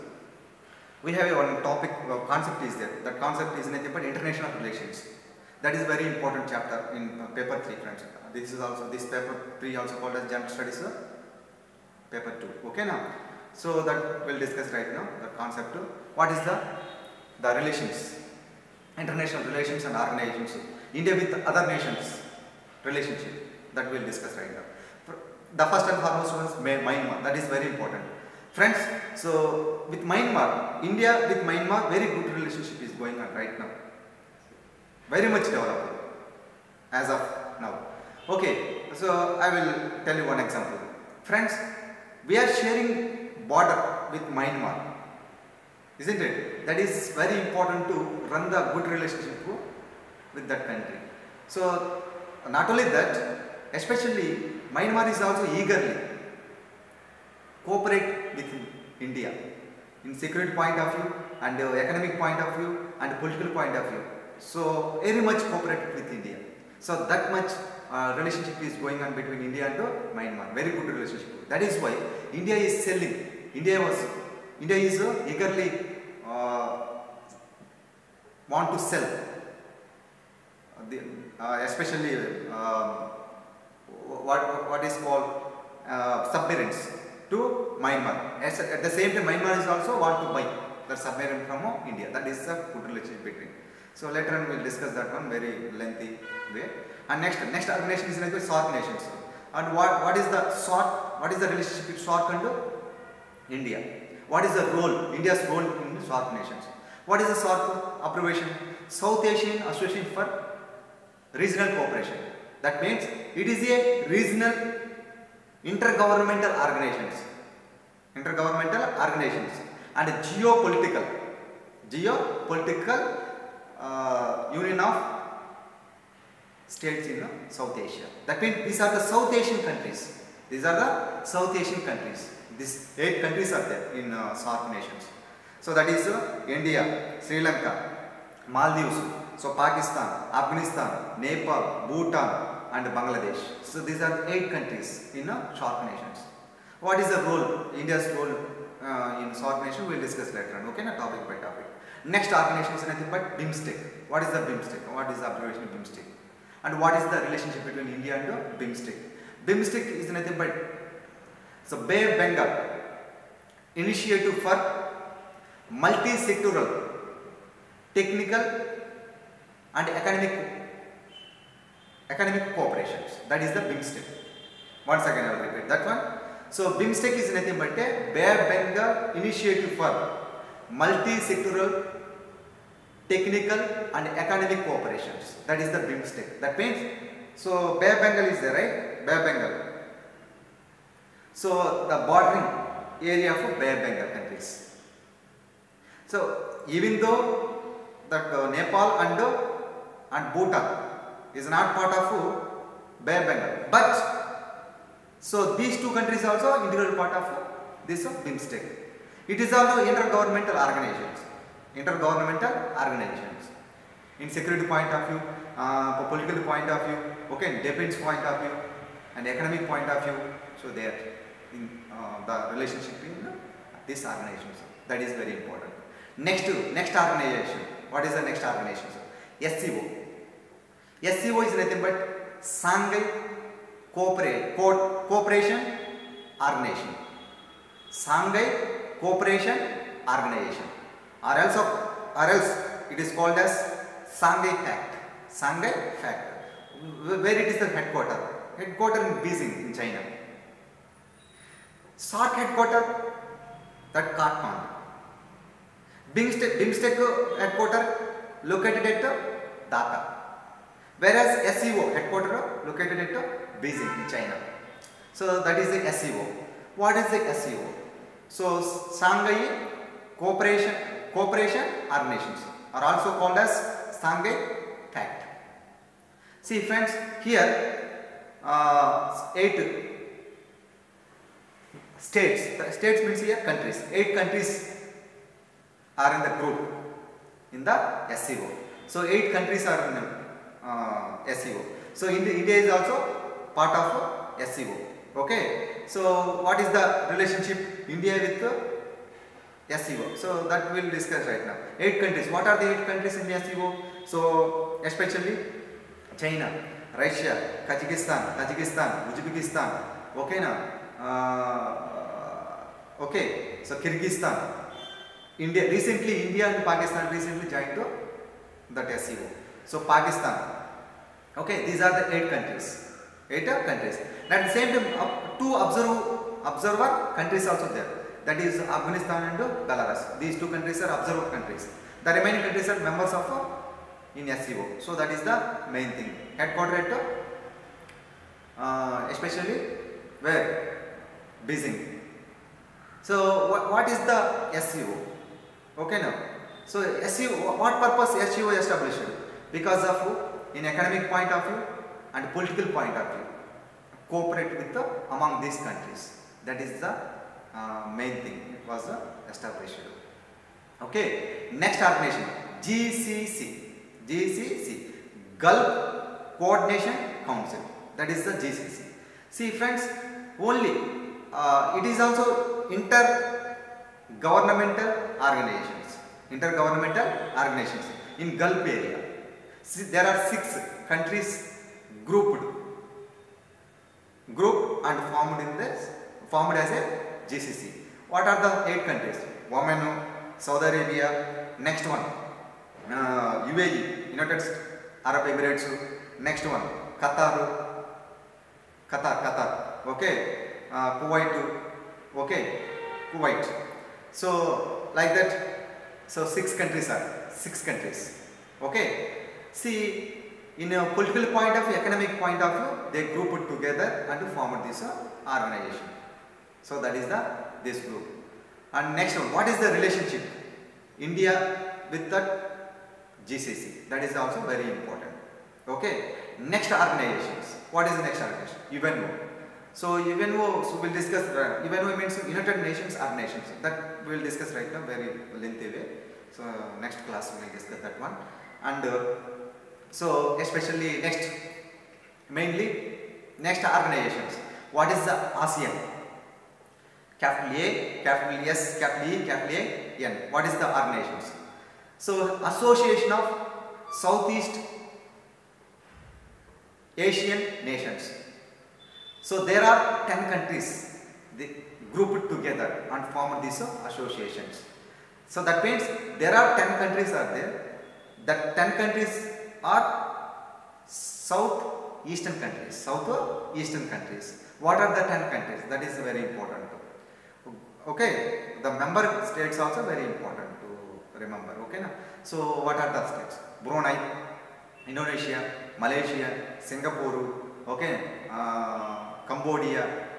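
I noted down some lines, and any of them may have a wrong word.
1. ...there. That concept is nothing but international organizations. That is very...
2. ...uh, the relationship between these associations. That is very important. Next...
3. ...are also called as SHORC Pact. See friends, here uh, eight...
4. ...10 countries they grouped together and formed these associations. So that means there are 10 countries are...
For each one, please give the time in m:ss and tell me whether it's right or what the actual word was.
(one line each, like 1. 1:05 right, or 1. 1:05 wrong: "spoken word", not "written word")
1. 0:02 wrong: "relations", not "organizations"
2. 3:41 wrong: "organizations", not "associations"
3. 4:32 wrong: "Shanghai", not "SHORC"
4. 7:40 right.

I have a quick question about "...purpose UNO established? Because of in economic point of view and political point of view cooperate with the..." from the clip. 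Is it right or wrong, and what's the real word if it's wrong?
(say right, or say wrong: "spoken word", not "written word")
wrong: "SEO", not "UNO".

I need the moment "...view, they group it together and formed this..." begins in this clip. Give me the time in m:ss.
6:52.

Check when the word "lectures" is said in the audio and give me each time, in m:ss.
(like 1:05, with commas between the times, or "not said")
not said.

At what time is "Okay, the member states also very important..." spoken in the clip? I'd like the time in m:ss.
7:57.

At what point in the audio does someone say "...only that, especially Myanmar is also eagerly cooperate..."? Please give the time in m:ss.
0:52.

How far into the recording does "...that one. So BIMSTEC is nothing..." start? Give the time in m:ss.
2:55.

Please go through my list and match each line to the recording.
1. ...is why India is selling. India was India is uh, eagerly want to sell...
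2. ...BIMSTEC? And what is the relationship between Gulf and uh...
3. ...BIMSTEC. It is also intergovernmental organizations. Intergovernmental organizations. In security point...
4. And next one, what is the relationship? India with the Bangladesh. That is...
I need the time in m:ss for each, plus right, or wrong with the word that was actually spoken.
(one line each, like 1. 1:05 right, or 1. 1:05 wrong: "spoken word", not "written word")
1. 1:11 right
2. 2:35 wrong: "India", not "Gulf"
3. 3:28 right
4. 6:58 wrong: "GCC", not "Bangladesh".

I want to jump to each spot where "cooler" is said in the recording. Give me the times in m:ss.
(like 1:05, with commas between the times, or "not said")
not said.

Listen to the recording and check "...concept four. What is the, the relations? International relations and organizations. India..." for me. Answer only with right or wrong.
wrong.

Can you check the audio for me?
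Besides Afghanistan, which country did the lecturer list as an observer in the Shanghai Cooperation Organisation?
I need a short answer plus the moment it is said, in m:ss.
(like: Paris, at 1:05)
Belarus, at 5:29.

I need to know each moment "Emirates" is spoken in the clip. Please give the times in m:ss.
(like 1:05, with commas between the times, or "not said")
6:35.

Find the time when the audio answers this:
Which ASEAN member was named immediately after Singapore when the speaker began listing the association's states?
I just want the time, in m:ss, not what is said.
8:09.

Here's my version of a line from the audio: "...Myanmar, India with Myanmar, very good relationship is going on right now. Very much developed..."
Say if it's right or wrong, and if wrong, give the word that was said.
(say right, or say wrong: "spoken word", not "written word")
right.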